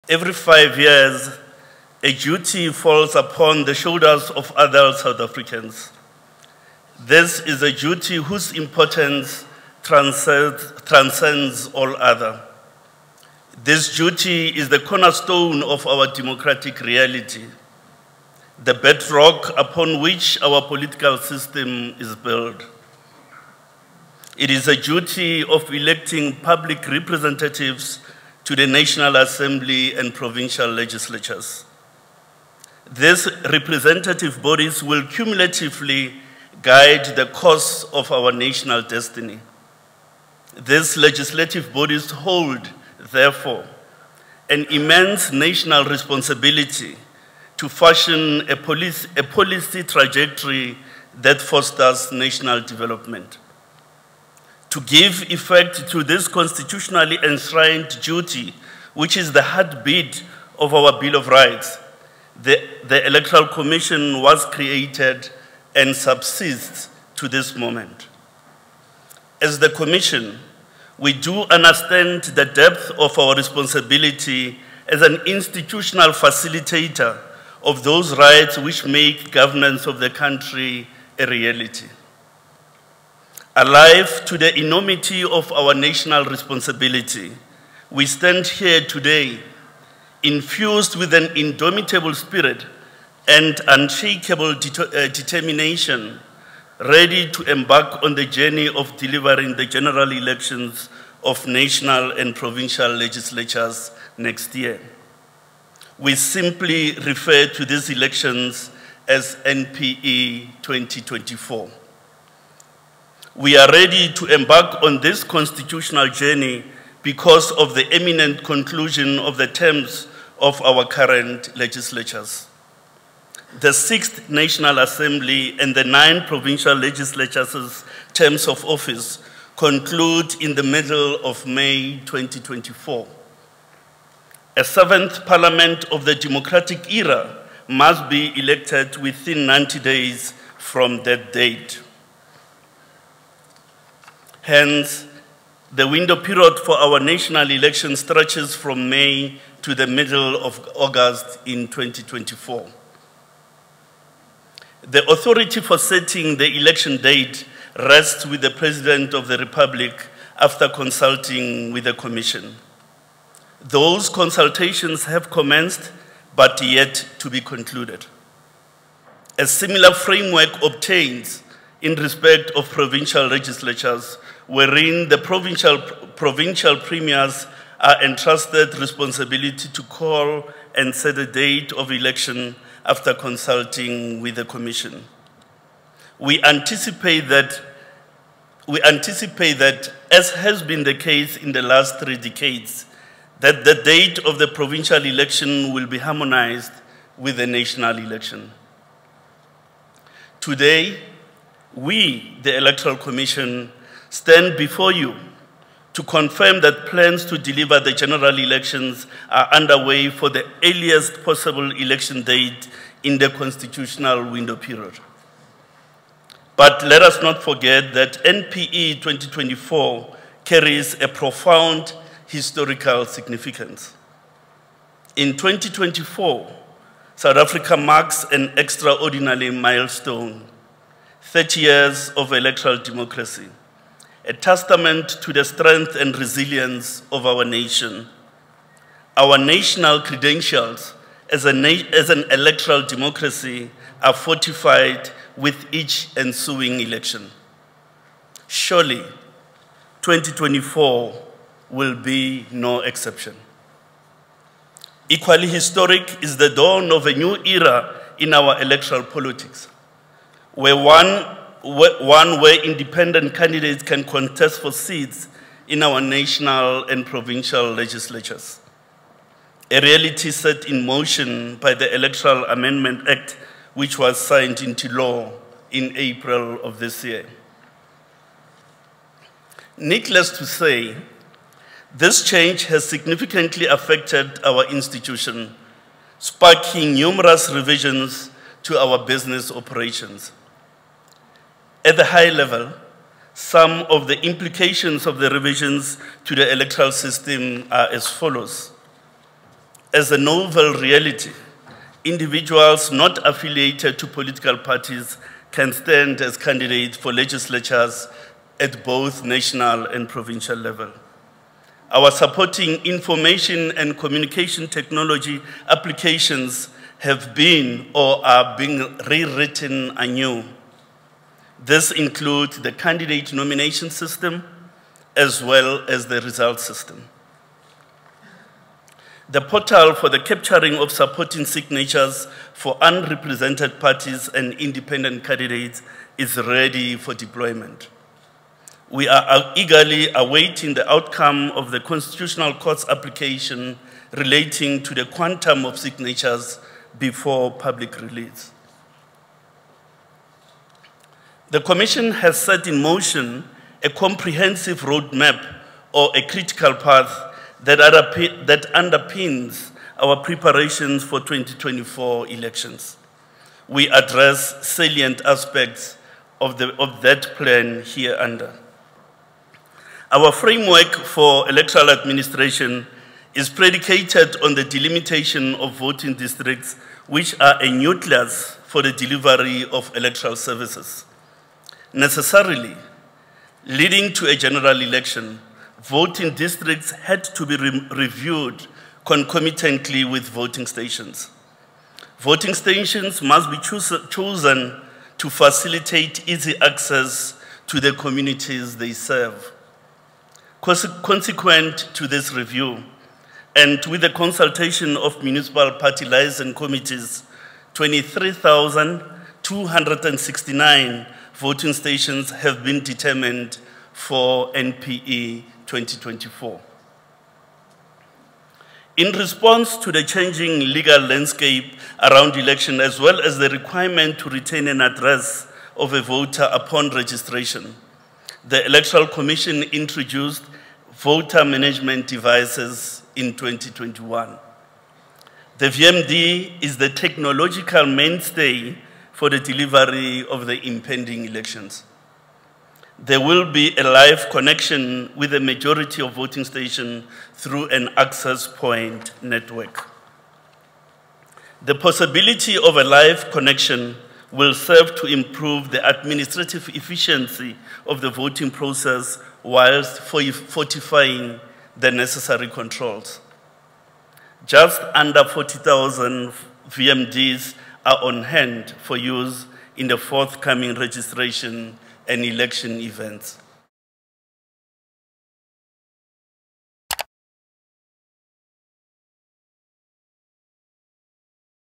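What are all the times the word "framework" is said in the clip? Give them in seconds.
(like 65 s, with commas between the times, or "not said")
169 s, 370 s.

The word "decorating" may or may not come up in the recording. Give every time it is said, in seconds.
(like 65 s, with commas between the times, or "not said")
not said.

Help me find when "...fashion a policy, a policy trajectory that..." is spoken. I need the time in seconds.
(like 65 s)
47 s.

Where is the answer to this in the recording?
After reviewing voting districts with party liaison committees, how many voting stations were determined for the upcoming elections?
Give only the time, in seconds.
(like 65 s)
407 s.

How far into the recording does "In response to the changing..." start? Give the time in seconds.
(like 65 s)
418 s.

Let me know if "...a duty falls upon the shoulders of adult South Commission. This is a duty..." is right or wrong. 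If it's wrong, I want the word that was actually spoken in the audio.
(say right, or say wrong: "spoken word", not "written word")
wrong: "Africans", not "Commission".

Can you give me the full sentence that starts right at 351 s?
The Commission has set in motion a comprehensive roadmap or a critical path that, underpins our preparations for 2024 elections.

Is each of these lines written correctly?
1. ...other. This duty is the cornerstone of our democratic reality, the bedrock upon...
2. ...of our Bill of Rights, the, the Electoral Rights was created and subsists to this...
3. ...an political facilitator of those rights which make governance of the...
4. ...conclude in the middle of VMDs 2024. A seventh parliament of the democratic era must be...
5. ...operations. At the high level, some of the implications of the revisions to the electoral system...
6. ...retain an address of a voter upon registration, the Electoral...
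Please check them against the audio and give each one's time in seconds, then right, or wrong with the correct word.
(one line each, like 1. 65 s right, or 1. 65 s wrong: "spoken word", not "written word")
1. 11 s right
2. 60 s wrong: "Commission", not "Rights"
3. 75 s wrong: "institutional", not "political"
4. 129 s wrong: "May", not "VMDs"
5. 289 s right
6. 424 s right.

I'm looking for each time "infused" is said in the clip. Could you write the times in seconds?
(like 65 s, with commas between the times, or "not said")
90 s.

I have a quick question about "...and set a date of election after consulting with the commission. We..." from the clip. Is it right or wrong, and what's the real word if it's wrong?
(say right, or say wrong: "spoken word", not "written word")
right.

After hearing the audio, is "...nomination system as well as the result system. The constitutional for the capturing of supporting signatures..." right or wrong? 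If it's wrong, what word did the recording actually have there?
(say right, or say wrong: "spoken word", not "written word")
wrong: "portal", not "constitutional".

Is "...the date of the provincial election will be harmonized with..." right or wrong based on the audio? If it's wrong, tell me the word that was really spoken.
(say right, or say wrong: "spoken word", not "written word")
right.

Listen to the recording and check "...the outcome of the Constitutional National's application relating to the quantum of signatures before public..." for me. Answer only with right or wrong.
wrong.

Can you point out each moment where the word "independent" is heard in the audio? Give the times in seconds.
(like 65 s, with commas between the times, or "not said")
262 s, 334 s.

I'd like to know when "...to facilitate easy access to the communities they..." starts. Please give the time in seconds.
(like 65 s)
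395 s.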